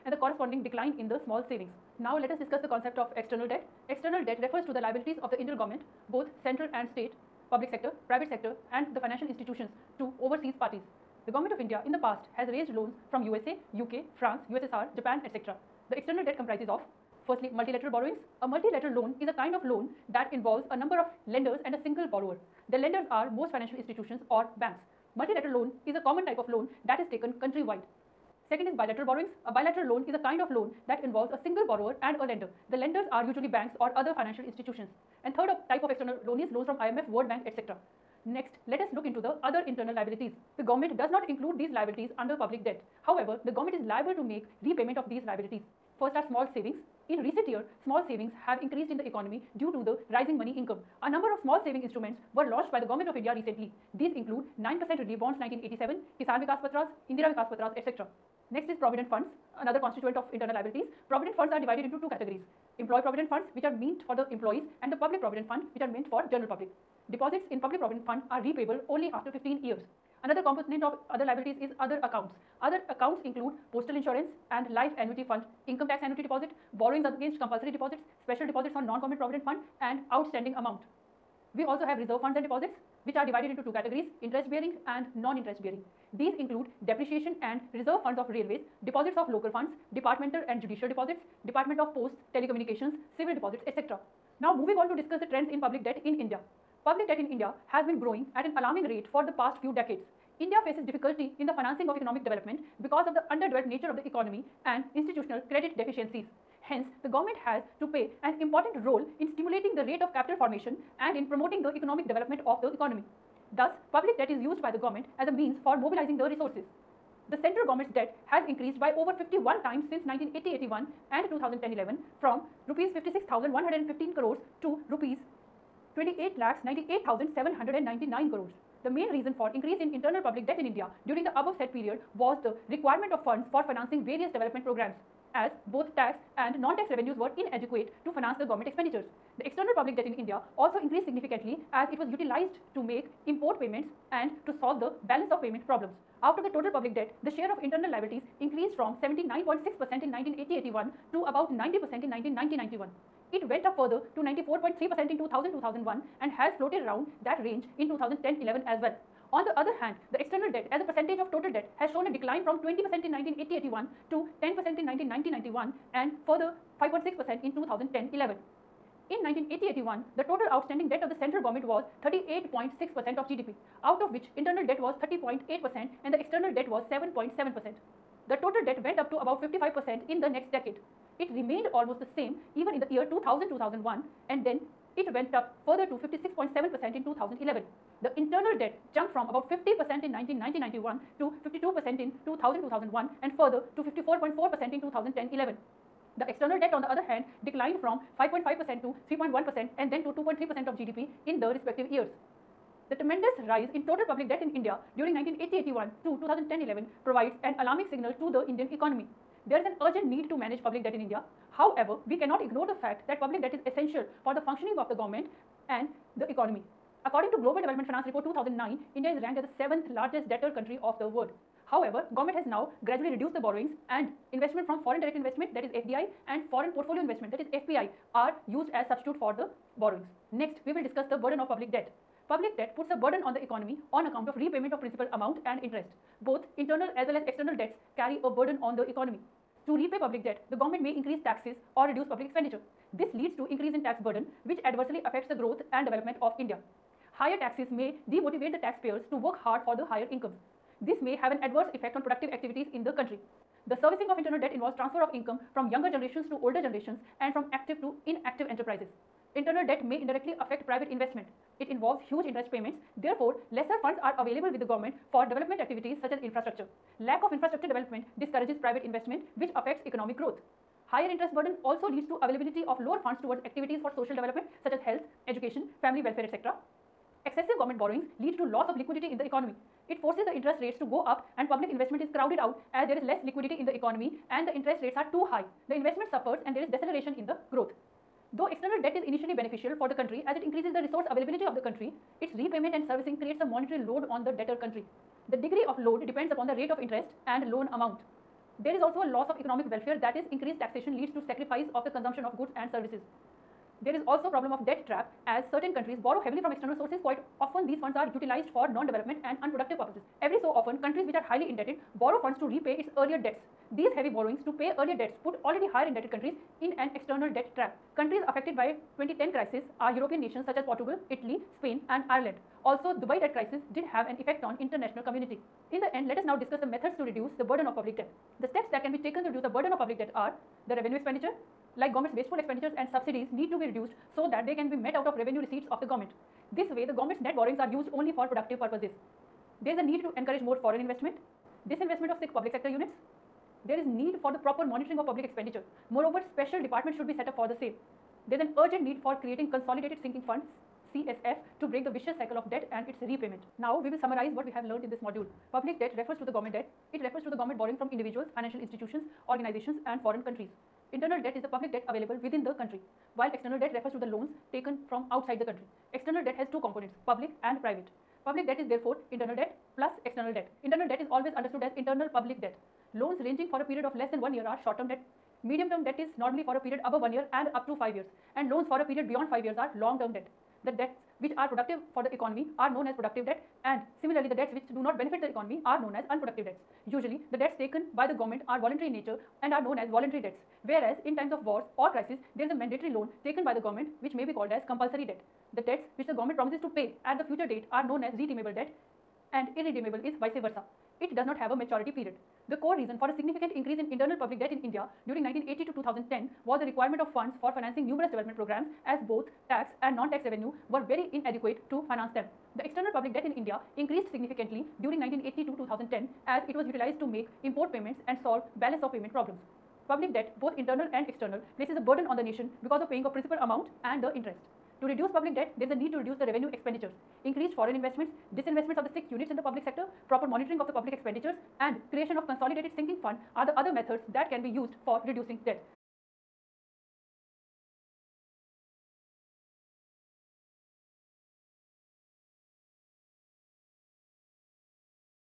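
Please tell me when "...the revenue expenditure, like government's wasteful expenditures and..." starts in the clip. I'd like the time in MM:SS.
05:30.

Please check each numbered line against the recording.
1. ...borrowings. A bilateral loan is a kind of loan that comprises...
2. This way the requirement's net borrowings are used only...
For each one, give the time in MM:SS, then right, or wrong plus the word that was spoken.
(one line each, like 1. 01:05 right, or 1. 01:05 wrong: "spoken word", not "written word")
1. 00:29 wrong: "involves", not "comprises"
2. 05:36 wrong: "government", not "requirement".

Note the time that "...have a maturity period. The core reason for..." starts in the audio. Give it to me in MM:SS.
06:41.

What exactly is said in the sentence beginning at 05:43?
There is need for the proper monitoring of public expenditure.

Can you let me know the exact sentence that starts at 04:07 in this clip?
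Higher taxes may demotivate the taxpayers to work hard for the higher incomes.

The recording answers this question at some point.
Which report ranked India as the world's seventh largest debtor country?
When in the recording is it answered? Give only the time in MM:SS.
03:37.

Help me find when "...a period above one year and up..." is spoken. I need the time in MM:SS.
06:16.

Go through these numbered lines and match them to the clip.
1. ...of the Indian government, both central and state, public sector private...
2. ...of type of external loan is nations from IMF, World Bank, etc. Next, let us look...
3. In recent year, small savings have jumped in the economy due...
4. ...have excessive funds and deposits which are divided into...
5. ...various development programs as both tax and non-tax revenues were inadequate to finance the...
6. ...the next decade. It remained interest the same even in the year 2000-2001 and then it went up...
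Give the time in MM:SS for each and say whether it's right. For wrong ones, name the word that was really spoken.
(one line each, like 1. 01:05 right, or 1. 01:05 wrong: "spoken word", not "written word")
1. 00:05 right
2. 00:35 wrong: "loans", not "nations"
3. 00:47 wrong: "increased", not "jumped"
4. 01:21 wrong: "reserve", not "excessive"
5. 02:14 right
6. 03:00 wrong: "almost", not "interest".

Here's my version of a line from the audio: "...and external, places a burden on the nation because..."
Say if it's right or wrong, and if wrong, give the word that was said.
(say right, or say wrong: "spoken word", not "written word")
right.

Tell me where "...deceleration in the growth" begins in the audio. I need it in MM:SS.
04:46.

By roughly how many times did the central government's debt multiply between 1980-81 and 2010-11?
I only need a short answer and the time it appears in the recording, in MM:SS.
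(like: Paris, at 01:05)
51 times, at 01:59.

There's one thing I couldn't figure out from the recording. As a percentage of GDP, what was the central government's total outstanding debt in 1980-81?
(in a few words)
38.6%.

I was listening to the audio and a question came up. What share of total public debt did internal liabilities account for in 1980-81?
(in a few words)
79.6%.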